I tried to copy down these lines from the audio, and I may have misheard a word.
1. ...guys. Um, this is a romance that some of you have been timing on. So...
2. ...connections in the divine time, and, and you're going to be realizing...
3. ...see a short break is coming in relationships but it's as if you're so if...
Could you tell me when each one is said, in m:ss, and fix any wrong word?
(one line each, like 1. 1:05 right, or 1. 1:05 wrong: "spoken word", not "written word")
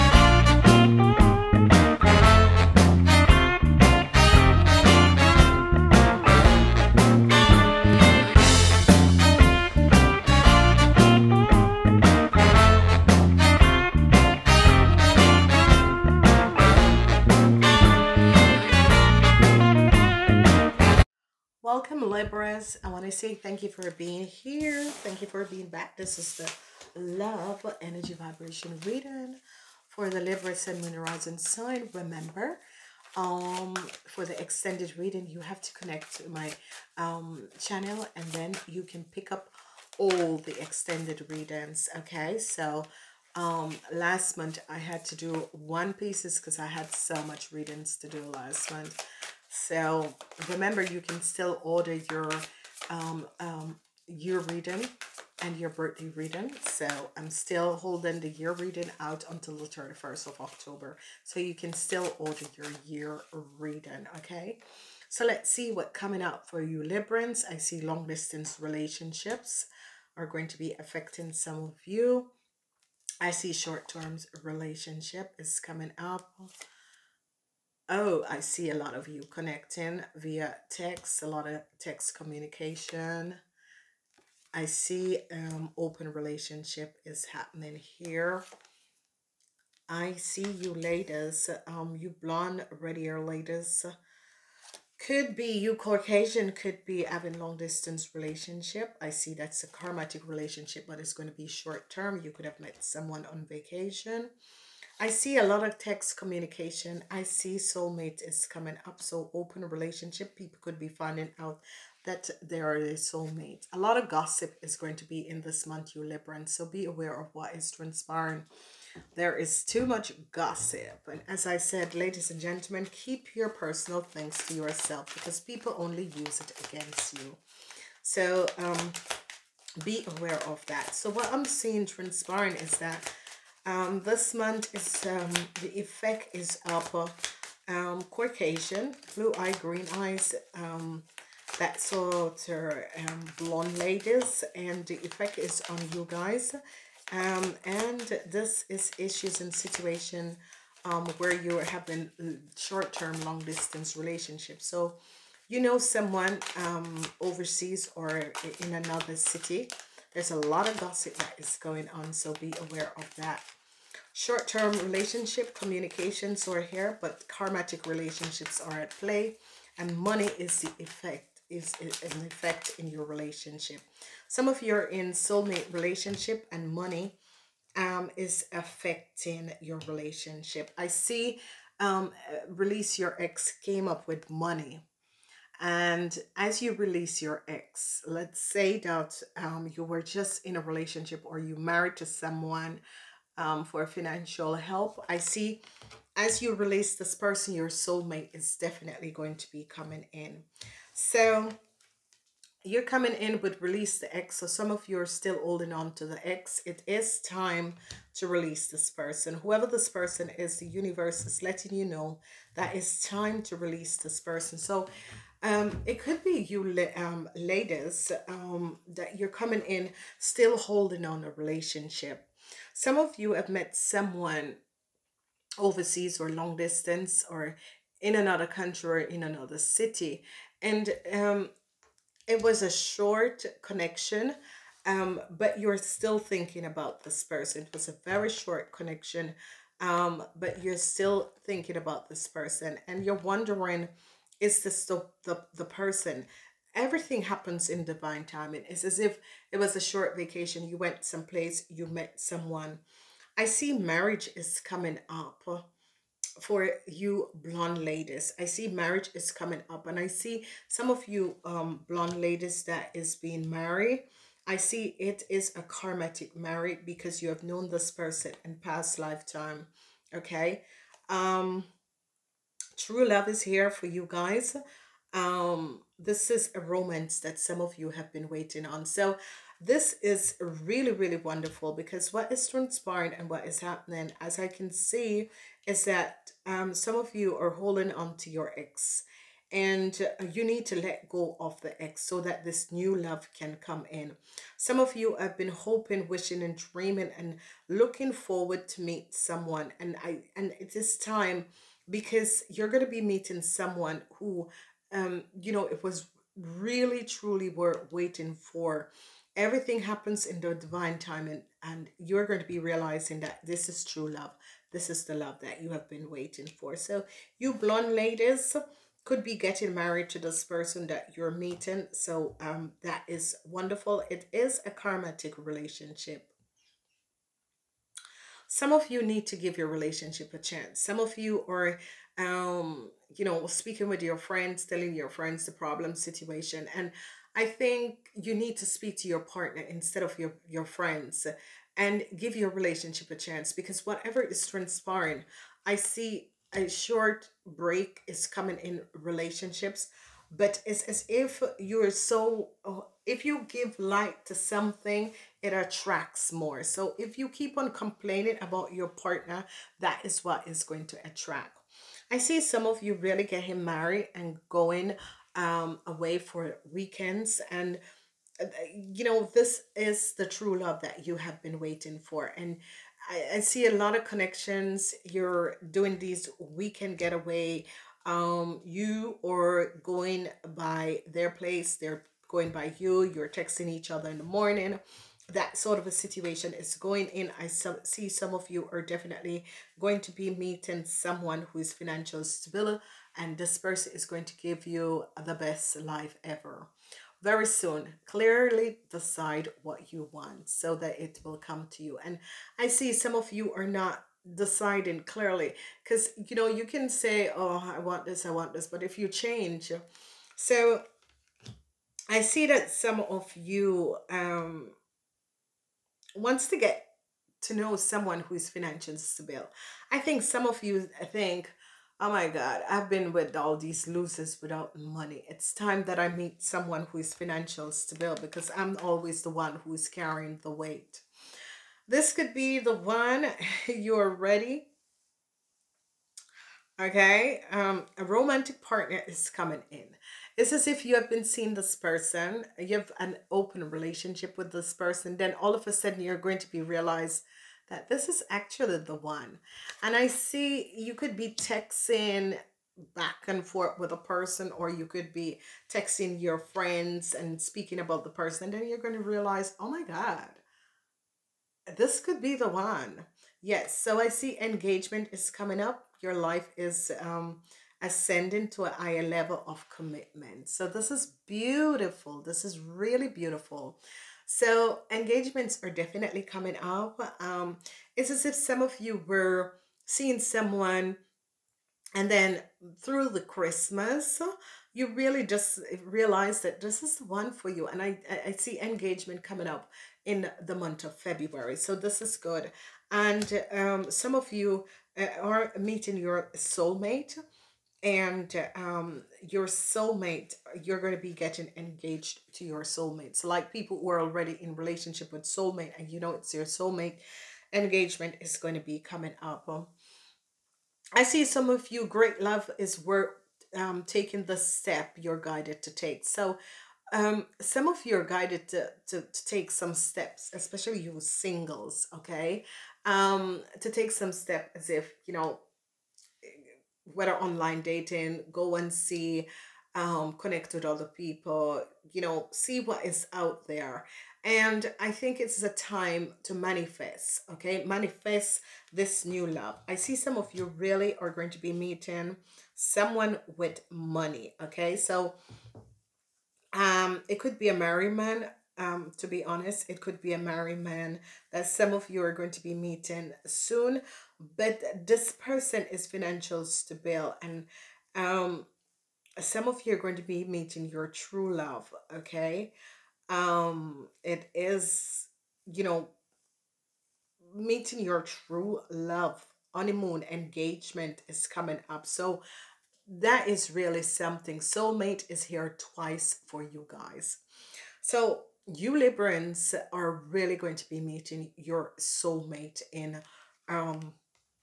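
1. 4:34 wrong: "waiting", not "timing"
2. 5:09 wrong: "happens", not "connections"
3. 5:45 right.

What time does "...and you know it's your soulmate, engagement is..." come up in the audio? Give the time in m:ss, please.
8:25.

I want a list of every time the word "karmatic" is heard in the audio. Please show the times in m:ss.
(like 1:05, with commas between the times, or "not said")
1:39, 2:47, 4:25, 5:24.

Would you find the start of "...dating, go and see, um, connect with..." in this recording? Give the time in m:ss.
8:47.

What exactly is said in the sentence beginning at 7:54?
So engagements are definitely coming up.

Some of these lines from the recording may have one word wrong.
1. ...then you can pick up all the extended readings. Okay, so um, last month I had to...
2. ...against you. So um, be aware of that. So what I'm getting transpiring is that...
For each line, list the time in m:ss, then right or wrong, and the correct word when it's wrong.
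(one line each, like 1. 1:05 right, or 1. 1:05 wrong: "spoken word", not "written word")
1. 0:38 right
2. 2:06 wrong: "seeing", not "getting".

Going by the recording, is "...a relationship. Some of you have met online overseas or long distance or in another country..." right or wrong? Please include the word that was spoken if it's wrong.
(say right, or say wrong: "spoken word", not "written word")
wrong: "someone", not "online".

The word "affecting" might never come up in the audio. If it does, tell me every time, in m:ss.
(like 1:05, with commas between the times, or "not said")
1:10, 2:58.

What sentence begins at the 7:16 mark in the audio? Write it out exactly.
Okay, um, a romantic partner is coming in.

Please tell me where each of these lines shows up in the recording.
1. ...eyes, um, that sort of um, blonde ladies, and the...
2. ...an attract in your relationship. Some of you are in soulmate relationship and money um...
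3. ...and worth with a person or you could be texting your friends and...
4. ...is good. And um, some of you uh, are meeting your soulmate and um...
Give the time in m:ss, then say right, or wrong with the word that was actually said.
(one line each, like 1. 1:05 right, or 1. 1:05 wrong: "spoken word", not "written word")
1. 2:19 right
2. 2:51 wrong: "effect", not "attract"
3. 7:33 wrong: "forth", not "worth"
4. 8:12 right.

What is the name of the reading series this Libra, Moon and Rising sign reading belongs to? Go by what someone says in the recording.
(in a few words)
Love Energy Vibration.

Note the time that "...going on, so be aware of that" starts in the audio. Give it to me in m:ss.
2:41.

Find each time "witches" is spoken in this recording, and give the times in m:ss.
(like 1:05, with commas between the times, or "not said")
not said.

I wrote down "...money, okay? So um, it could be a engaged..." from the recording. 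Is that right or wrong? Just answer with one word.
wrong.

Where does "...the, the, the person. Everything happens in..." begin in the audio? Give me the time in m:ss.
4:04.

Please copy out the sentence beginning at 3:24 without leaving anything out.
So some of you are still holding on to the ex.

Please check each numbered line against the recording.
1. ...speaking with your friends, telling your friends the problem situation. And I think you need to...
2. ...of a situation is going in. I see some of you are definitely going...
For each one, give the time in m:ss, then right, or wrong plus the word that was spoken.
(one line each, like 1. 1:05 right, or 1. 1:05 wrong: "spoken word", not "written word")
1. 5:33 right
2. 6:25 right.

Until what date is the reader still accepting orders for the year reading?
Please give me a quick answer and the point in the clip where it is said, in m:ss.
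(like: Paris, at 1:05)
October 31, at 0:59.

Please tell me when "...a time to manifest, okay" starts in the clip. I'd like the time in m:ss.
8:55.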